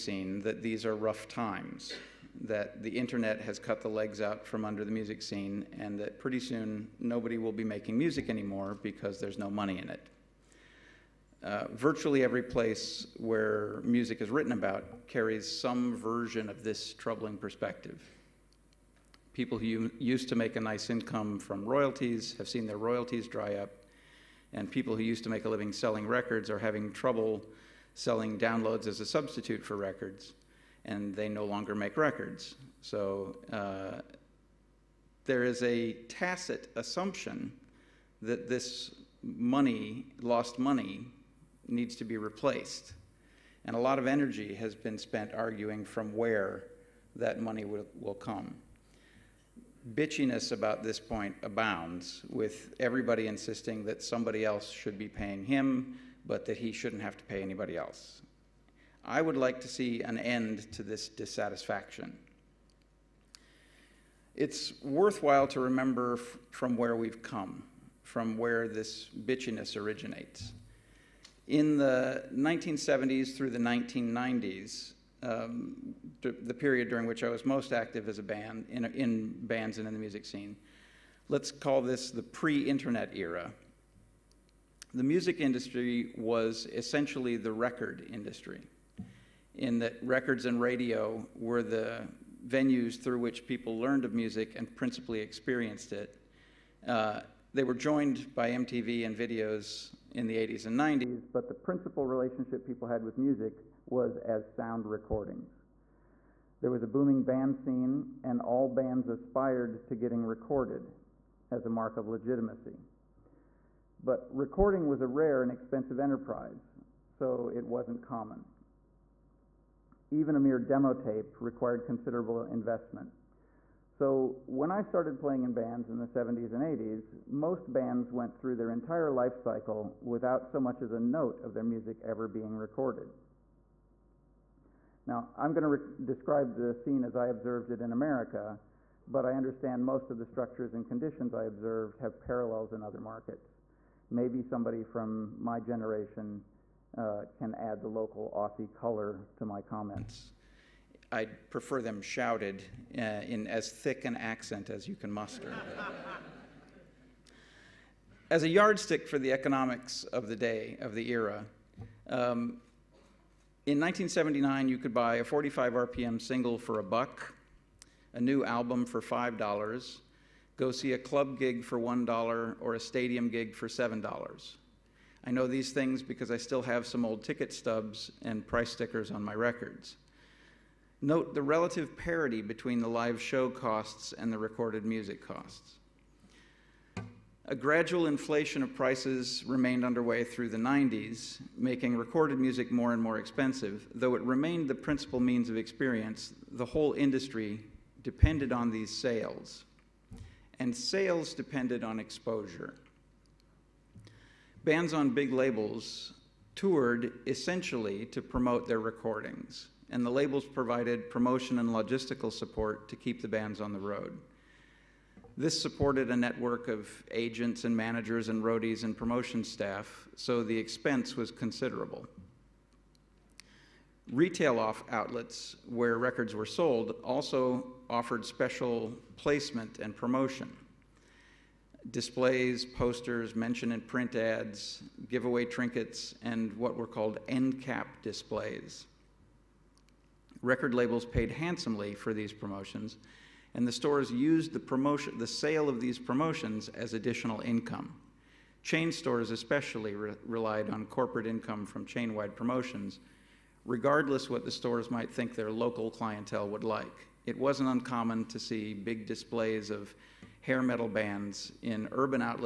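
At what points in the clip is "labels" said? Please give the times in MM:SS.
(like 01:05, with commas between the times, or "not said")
03:25, 03:30, 04:00.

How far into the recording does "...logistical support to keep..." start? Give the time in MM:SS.
03:31.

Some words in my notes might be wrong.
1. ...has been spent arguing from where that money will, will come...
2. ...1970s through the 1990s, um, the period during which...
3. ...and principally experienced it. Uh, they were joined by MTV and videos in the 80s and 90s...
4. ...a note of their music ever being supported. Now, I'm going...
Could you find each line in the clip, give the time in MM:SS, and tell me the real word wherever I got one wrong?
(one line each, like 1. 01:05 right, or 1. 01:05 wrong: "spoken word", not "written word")
1. 00:44 right
2. 01:12 right
3. 01:34 right
4. 02:10 wrong: "recorded", not "supported".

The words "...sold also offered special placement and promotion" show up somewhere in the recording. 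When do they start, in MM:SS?
03:46.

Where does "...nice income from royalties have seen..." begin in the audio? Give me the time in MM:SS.
00:20.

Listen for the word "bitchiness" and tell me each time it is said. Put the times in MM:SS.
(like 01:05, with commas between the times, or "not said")
00:49, 01:09.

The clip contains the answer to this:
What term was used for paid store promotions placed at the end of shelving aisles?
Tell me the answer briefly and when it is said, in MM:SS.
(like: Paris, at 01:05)
end cap displays, at 03:57.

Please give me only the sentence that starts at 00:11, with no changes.
Uh, virtually every place where music is written about carries some version of this troubling perspective.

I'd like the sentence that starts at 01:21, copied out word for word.
Let's call this the pre internet era.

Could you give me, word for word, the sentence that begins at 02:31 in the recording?
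I would prefer them shouted uh, in as thick an accent as you can muster.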